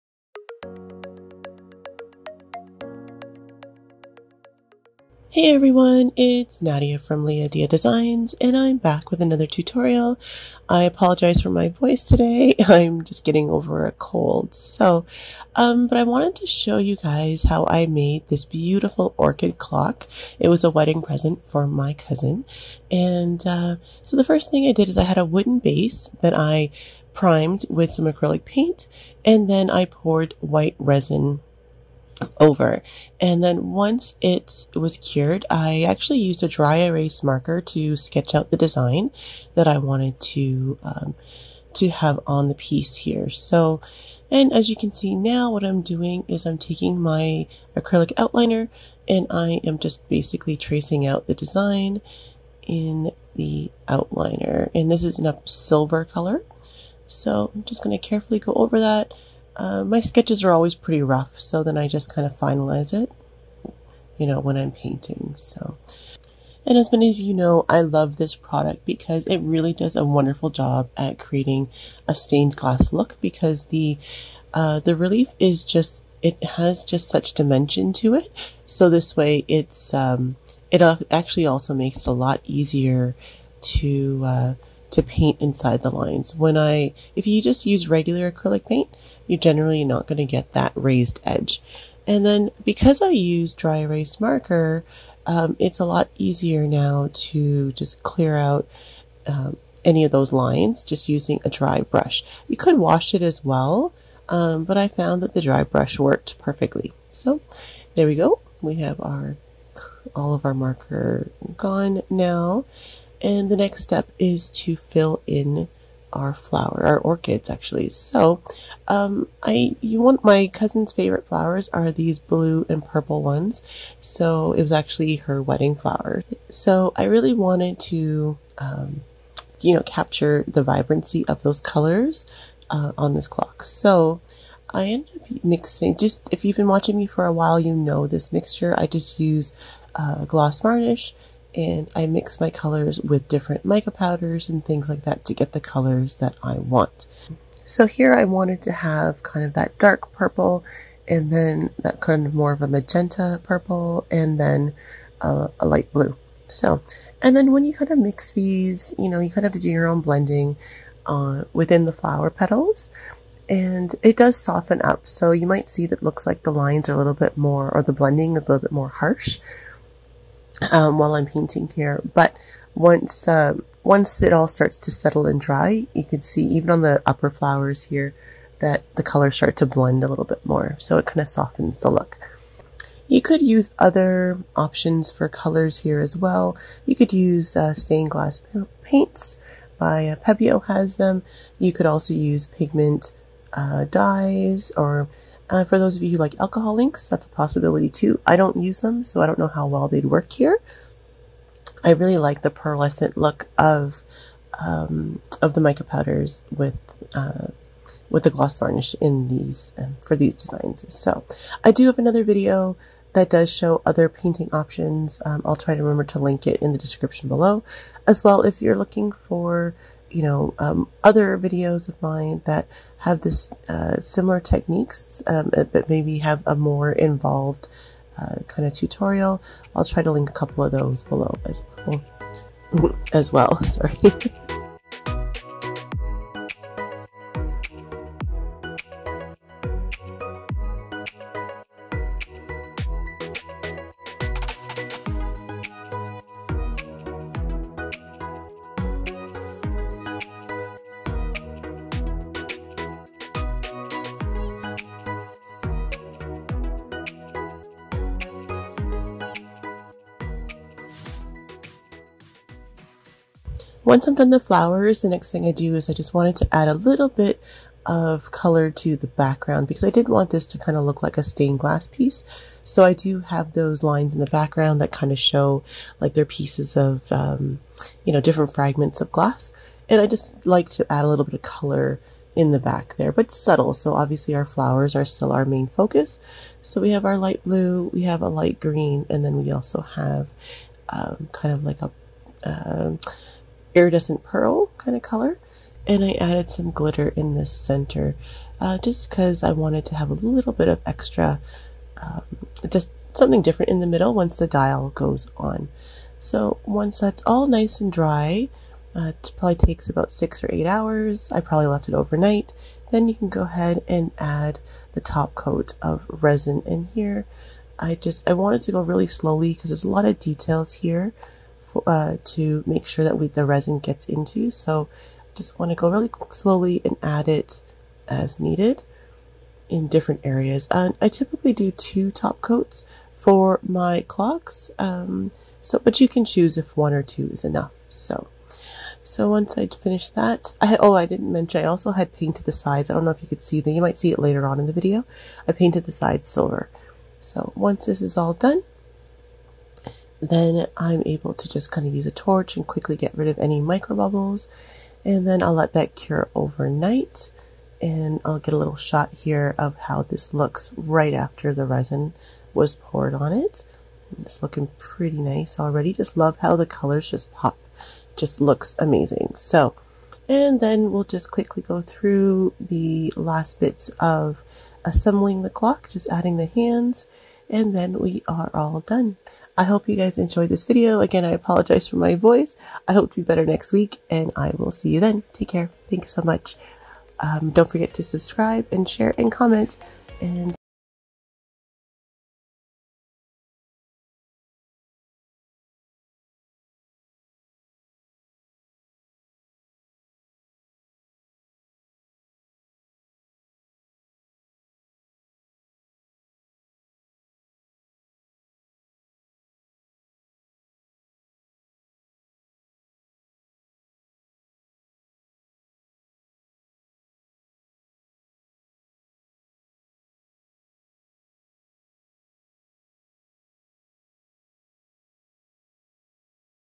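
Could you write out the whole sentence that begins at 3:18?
I don't use them, so I don't know how well they'd work here.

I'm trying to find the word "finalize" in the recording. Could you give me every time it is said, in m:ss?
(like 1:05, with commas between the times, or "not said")
1:02.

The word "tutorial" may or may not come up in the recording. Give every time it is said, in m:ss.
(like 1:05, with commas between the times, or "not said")
0:09, 3:48.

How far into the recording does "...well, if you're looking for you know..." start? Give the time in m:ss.
3:38.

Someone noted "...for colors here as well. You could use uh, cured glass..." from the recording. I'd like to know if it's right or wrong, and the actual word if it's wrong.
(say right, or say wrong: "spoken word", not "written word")
wrong: "stained", not "cured".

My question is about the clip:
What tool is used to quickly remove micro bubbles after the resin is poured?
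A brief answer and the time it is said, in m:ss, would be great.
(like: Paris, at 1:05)
torch, at 5:52.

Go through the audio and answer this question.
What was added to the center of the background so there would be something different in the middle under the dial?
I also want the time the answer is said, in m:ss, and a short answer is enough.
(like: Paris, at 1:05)
glitter, at 4:56.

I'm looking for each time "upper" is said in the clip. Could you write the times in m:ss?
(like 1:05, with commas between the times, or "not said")
2:57.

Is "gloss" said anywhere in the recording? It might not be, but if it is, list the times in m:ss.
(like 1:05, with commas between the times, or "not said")
2:20, 3:28.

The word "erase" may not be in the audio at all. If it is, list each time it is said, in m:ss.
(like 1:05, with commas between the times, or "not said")
0:36, 1:33.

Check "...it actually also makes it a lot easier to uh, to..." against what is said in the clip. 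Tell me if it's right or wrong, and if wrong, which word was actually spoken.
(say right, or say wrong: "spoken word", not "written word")
right.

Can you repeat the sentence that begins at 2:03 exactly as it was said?
So it was actually her wedding flower.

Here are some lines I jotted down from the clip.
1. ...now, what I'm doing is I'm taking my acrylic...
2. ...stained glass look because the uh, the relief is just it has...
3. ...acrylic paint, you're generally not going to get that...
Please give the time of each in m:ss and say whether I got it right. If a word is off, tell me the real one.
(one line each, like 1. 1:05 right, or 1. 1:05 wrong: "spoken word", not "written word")
1. 0:45 right
2. 1:12 right
3. 1:28 right.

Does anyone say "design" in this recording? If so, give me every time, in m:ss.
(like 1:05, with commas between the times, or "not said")
0:07, 0:38, 0:51, 3:30.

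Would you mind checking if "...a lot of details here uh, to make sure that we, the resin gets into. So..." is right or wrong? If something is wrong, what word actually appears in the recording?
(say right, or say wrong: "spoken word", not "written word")
right.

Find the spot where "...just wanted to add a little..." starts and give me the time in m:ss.
4:25.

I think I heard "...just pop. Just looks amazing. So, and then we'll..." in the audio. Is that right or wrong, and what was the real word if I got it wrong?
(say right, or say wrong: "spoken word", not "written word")
right.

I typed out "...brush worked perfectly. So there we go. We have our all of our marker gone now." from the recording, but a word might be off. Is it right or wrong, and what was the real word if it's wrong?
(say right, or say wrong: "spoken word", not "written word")
right.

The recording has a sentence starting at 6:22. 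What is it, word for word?
I hope to be better next week and I will see you then.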